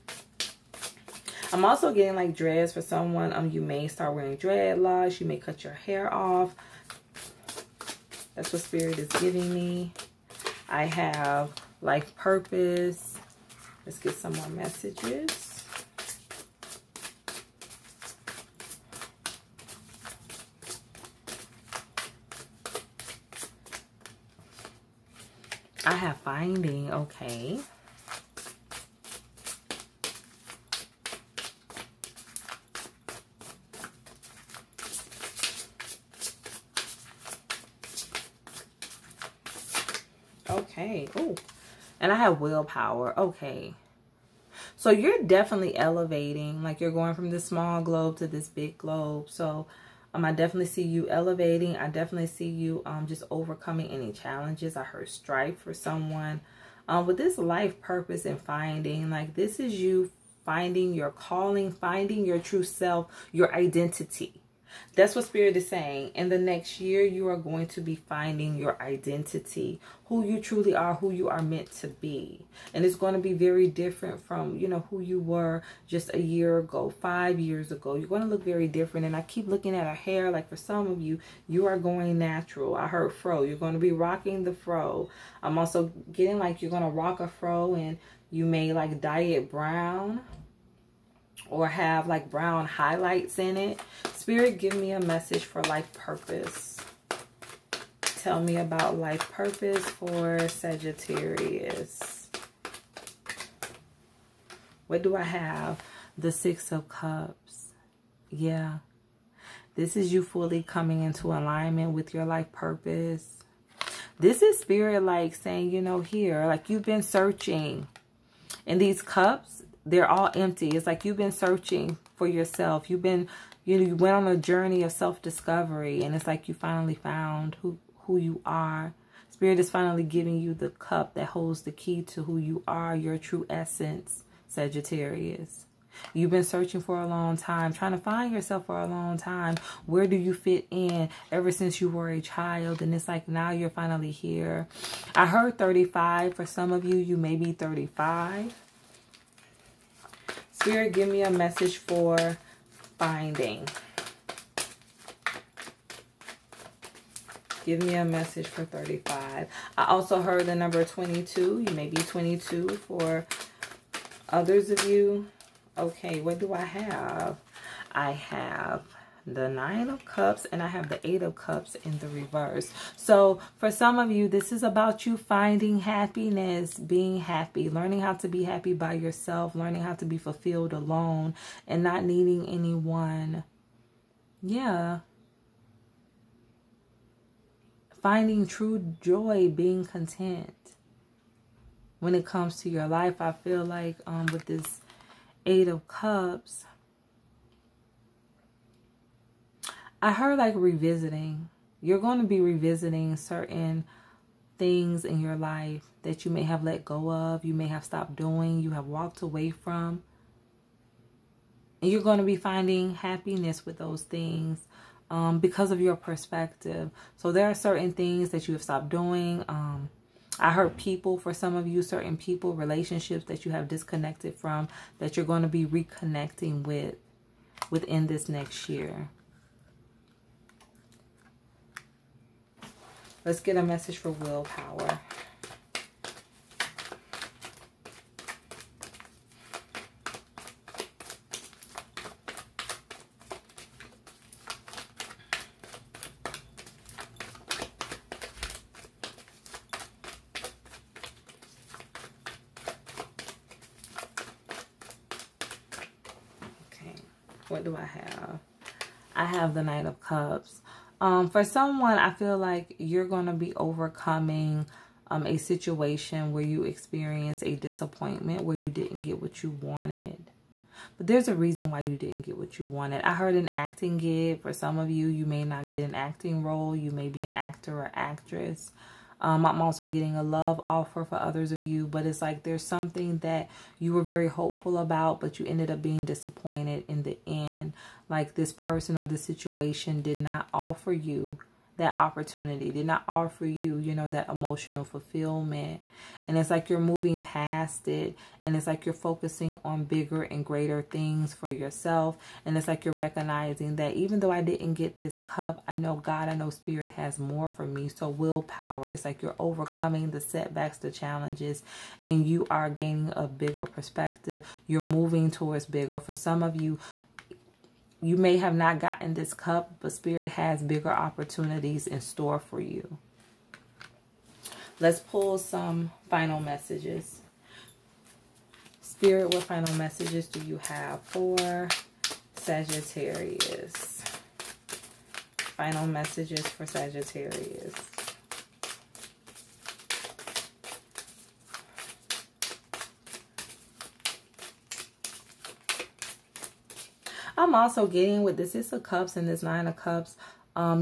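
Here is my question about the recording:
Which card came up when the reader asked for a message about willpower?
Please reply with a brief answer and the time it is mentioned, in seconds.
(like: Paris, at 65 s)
Knight of Cups, at 259 s.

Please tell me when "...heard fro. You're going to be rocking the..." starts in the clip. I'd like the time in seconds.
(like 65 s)
82 s.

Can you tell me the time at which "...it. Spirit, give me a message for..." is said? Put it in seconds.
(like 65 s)
93 s.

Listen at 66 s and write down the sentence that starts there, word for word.
In the next year, you are going to be finding your identity, who you truly are, who you are meant to be.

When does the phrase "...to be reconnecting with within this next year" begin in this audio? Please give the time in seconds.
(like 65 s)
225 s.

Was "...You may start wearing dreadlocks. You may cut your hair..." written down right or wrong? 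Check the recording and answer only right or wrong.
right.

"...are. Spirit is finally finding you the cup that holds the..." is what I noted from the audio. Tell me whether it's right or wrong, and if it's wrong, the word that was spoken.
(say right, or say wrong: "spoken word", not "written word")
wrong: "giving", not "finding".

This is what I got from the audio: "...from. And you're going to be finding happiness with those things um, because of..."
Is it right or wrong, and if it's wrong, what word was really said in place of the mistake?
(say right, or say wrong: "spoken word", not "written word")
right.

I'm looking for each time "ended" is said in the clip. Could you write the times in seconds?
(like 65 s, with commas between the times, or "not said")
285 s.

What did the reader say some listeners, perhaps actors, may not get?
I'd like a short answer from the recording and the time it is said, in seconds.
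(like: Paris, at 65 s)
An acting gig, at 273 s.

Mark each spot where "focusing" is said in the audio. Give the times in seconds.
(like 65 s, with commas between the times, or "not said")
298 s.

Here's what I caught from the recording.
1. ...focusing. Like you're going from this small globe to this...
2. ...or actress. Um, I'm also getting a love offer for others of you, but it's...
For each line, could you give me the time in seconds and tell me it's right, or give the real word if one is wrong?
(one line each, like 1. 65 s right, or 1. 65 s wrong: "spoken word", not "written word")
1. 45 s wrong: "elevating", not "focusing"
2. 277 s right.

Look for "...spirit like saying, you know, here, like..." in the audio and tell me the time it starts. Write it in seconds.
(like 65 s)
114 s.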